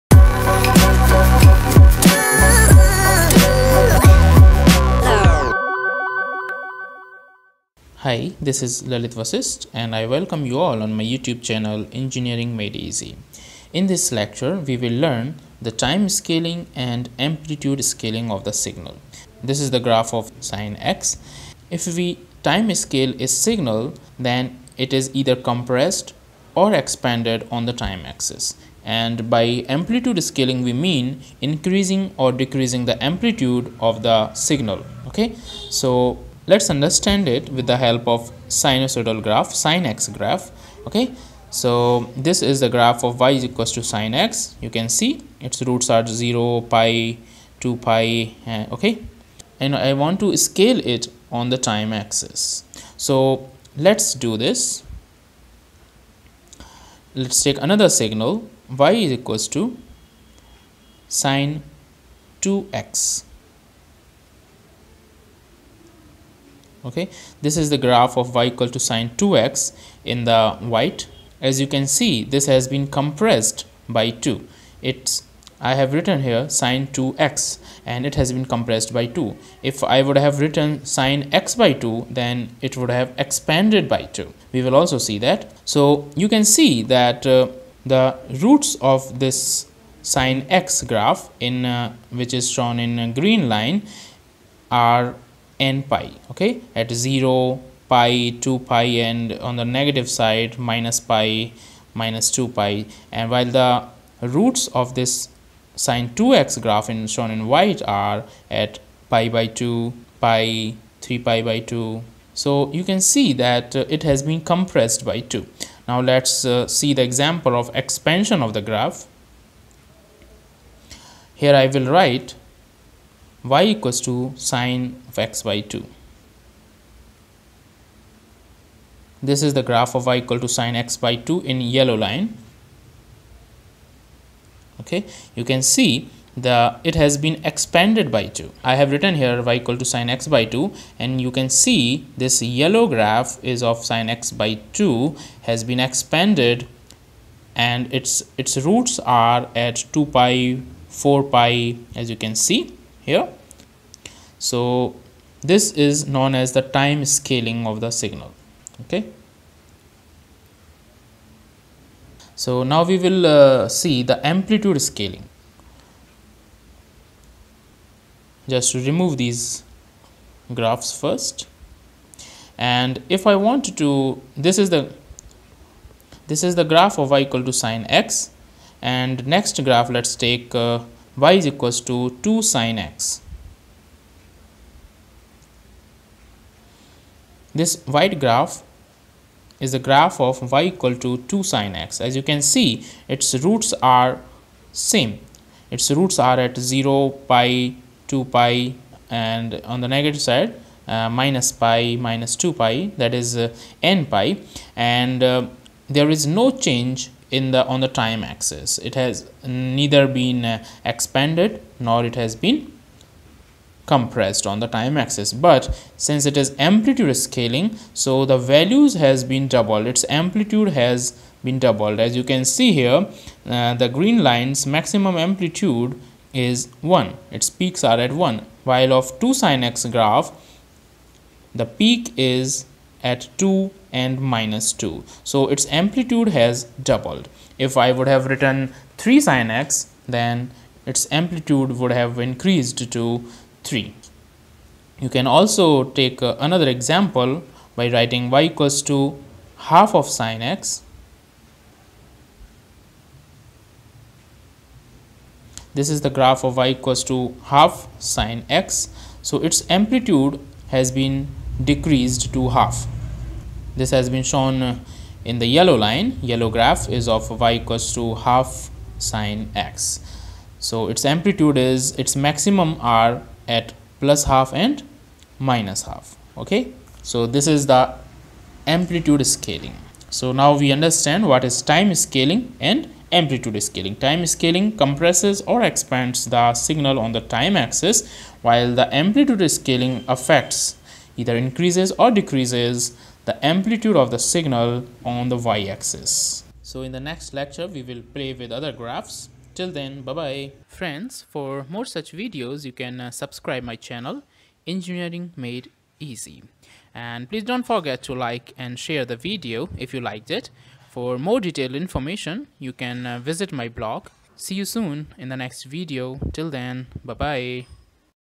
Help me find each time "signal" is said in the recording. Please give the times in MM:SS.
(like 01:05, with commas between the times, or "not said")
00:18, 00:23, 00:34, 00:57, 02:37, 04:46, 04:54.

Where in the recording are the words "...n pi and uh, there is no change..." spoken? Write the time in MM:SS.
03:23.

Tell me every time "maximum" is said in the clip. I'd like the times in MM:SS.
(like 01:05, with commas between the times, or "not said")
03:44, 04:32.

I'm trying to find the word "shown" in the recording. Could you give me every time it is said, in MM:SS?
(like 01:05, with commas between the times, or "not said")
01:32, 01:47, 04:24.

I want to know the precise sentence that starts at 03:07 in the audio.
This white graph is the graph of y equal to 2 sine x.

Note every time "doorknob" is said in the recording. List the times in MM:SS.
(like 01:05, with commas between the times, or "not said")
not said.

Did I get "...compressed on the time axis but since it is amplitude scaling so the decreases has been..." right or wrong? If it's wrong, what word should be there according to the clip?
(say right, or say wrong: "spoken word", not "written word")
wrong: "values", not "decreases".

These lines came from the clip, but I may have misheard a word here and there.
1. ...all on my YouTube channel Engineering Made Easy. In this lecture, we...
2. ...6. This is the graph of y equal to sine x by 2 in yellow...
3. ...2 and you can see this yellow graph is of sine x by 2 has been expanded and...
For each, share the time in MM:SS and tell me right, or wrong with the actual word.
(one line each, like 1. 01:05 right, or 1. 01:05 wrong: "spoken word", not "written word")
1. 00:10 right
2. 02:05 wrong: "2", not "6"
3. 02:20 right.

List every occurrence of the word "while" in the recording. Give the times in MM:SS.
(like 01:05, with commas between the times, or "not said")
01:43, 03:48, 04:48.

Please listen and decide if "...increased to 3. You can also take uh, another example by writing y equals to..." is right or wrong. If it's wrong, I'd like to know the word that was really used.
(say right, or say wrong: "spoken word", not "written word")
right.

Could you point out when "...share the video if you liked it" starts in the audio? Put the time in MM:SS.
05:08.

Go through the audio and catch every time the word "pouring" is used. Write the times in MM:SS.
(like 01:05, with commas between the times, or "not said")
not said.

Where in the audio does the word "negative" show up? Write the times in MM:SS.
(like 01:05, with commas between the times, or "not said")
01:39, 03:19.